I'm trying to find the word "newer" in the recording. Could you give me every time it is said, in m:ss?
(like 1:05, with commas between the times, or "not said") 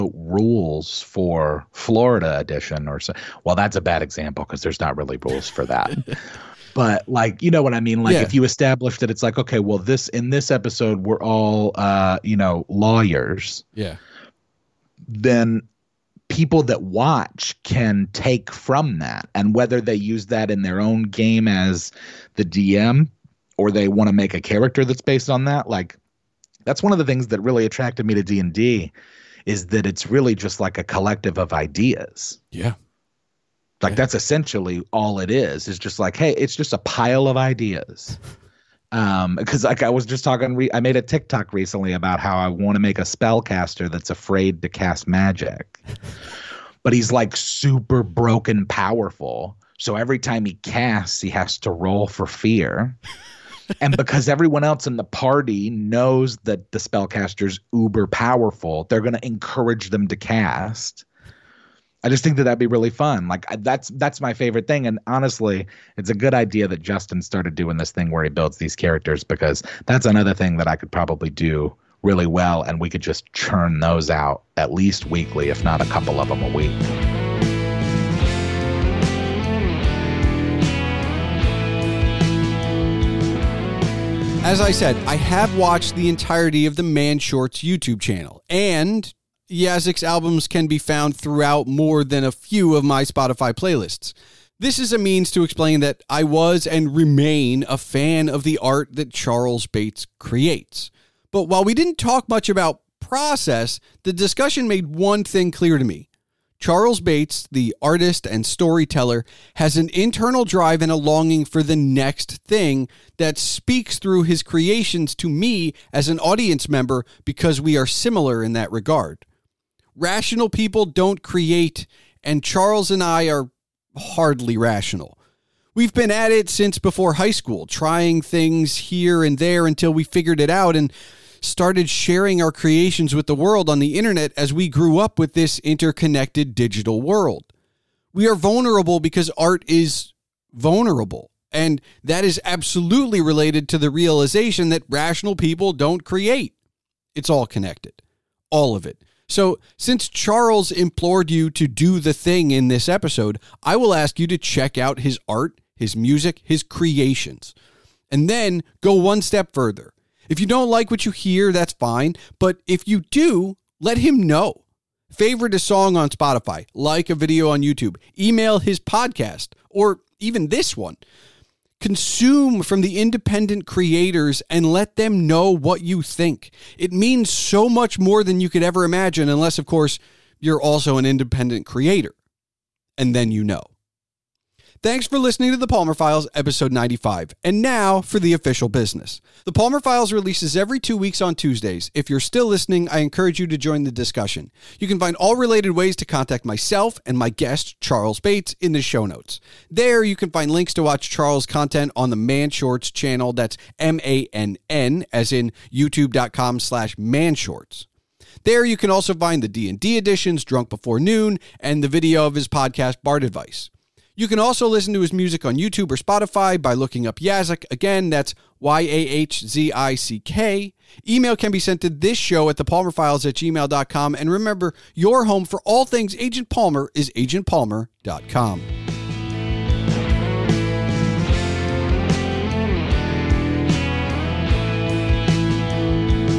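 not said.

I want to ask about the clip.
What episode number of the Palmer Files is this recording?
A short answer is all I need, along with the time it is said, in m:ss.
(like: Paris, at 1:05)
95, at 3:06.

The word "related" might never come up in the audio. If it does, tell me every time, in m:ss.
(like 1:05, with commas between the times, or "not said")
2:23, 3:15.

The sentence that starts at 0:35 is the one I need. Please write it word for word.
It's just like, hey, it's just a pile of ideas.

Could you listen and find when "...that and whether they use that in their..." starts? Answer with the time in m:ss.
0:18.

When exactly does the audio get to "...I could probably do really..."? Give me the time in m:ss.
1:10.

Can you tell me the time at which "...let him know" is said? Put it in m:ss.
2:43.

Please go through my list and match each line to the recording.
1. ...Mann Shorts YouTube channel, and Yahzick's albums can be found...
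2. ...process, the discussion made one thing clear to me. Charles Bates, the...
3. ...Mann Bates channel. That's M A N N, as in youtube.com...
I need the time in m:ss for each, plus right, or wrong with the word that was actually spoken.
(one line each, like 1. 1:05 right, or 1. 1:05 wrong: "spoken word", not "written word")
1. 1:26 right
2. 1:43 right
3. 3:22 wrong: "Shorts", not "Bates".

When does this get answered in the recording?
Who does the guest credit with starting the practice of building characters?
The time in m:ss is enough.
1:06.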